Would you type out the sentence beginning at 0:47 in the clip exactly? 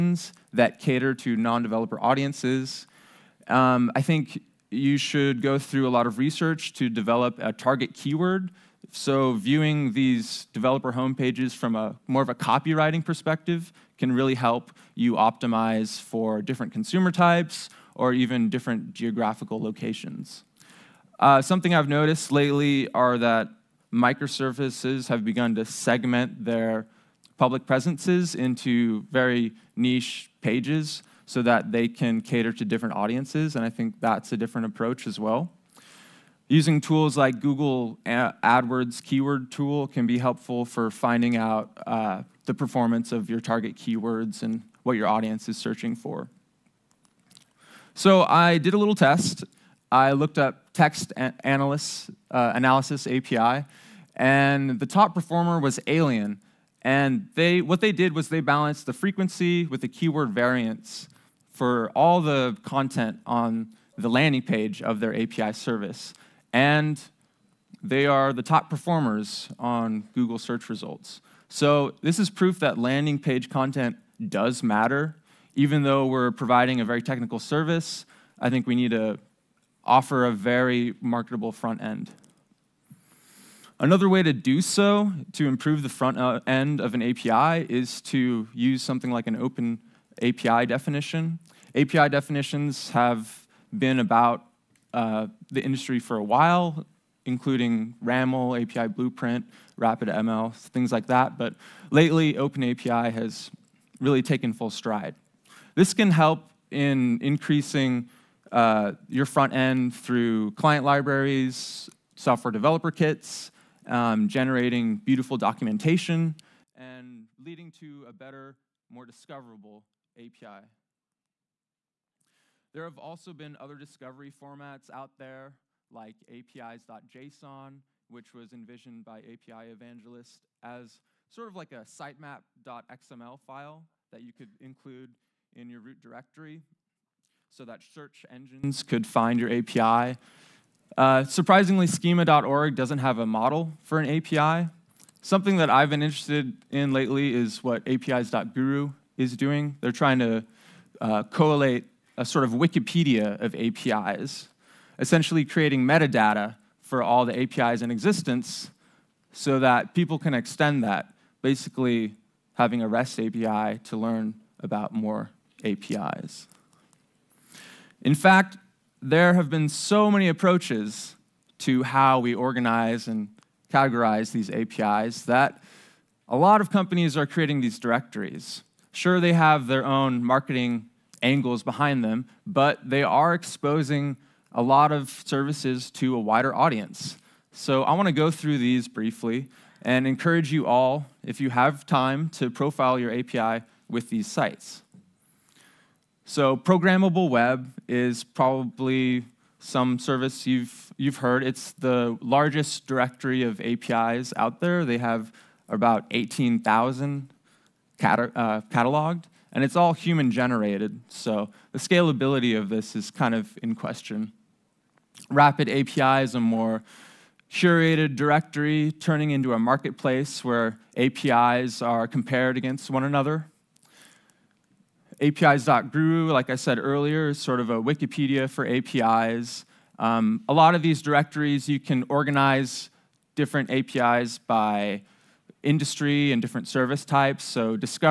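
So I did a little test.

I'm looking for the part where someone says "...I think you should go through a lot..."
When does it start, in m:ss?
0:03.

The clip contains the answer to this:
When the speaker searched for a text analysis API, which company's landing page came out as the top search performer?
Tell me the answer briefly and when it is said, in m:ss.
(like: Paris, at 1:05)
AYLIEN, at 0:55.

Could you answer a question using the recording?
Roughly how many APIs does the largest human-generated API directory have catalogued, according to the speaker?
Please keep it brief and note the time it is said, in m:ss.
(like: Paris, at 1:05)
18,000, at 3:26.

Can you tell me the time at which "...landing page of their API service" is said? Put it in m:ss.
1:04.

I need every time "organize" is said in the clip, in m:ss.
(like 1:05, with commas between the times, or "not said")
2:52, 3:52.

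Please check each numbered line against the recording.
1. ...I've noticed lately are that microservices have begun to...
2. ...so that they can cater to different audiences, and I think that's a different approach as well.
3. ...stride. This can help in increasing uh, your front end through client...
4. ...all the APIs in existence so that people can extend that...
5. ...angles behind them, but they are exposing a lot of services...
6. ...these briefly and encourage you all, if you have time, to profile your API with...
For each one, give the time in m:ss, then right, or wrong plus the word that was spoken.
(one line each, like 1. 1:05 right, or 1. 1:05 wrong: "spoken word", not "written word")
1. 0:21 right
2. 0:31 right
3. 1:44 right
4. 2:37 right
5. 3:01 right
6. 3:08 right.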